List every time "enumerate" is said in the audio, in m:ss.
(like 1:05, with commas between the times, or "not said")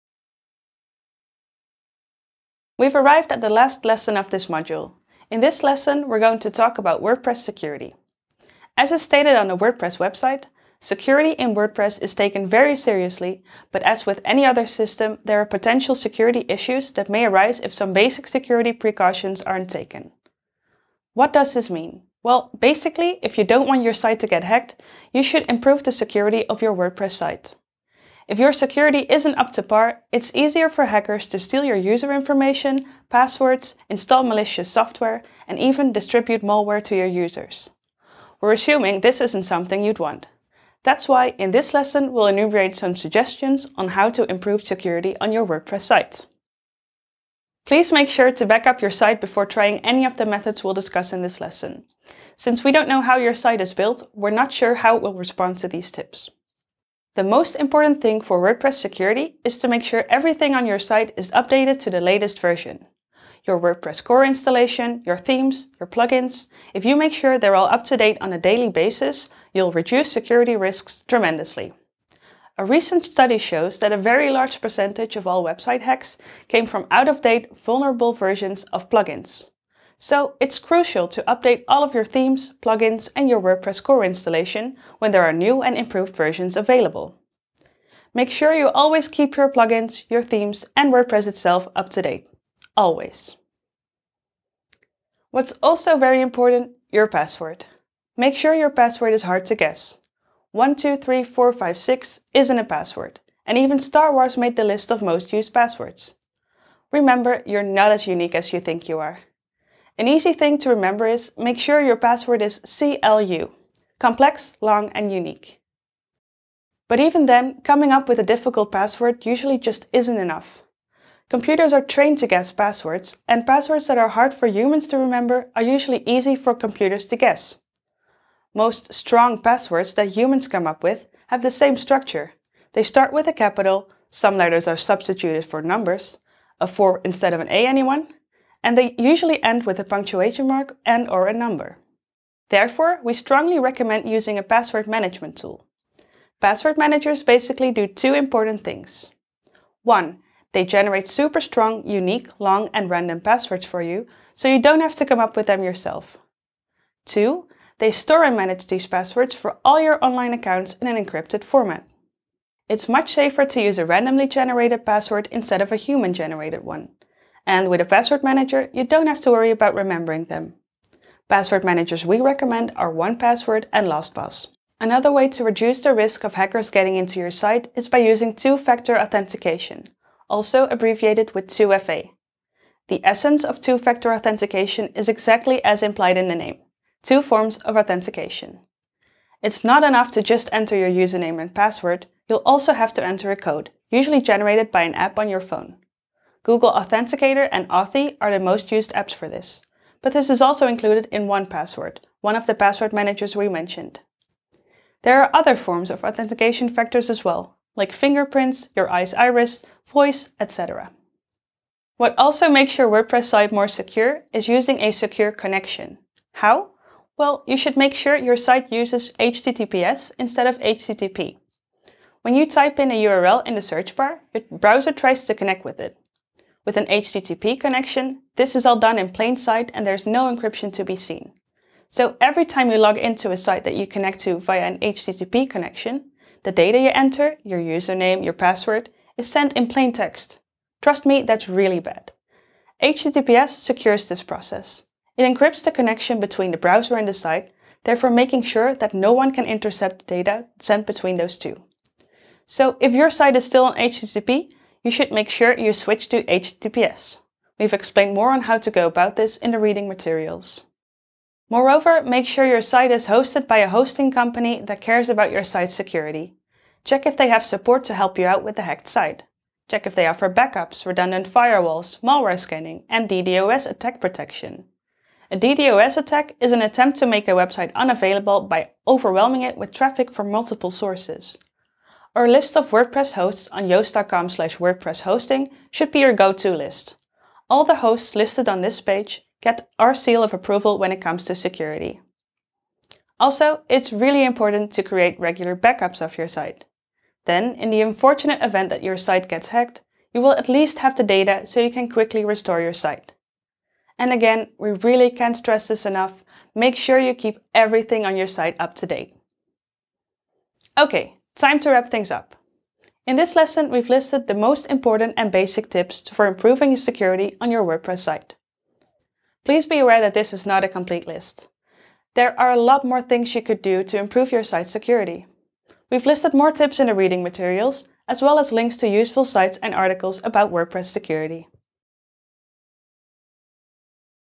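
0:42.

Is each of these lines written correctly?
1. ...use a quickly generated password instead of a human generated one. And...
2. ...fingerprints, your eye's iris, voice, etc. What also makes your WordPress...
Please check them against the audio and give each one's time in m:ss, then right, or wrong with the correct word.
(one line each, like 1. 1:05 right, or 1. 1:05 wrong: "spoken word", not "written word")
1. 2:43 wrong: "randomly", not "quickly"
2. 3:27 right.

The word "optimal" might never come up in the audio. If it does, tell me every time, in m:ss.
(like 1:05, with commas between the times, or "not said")
not said.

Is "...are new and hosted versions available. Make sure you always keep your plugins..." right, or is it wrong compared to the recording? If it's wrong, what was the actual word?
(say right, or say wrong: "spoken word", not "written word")
wrong: "improved", not "hosted".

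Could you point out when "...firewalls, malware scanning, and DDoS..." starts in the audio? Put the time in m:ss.
4:31.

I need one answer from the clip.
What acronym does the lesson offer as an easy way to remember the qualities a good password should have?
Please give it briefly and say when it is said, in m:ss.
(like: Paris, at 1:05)
CLU, at 1:52.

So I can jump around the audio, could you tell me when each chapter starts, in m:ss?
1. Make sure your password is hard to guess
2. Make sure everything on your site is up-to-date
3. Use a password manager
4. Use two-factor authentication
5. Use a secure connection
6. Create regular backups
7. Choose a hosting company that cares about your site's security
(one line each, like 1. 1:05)
1. 1:35
2. 0:56
3. 1:56
4. 2:54
5. 3:32
6. 4:53
7. 4:21.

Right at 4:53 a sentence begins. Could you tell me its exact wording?
Also, it's really important to create regular backups of your site.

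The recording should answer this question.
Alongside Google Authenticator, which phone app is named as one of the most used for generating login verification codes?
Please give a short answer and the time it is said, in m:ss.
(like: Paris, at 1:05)
Authy, at 3:17.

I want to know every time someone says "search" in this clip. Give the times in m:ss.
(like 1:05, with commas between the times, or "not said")
3:43.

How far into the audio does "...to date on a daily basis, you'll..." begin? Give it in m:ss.
1:07.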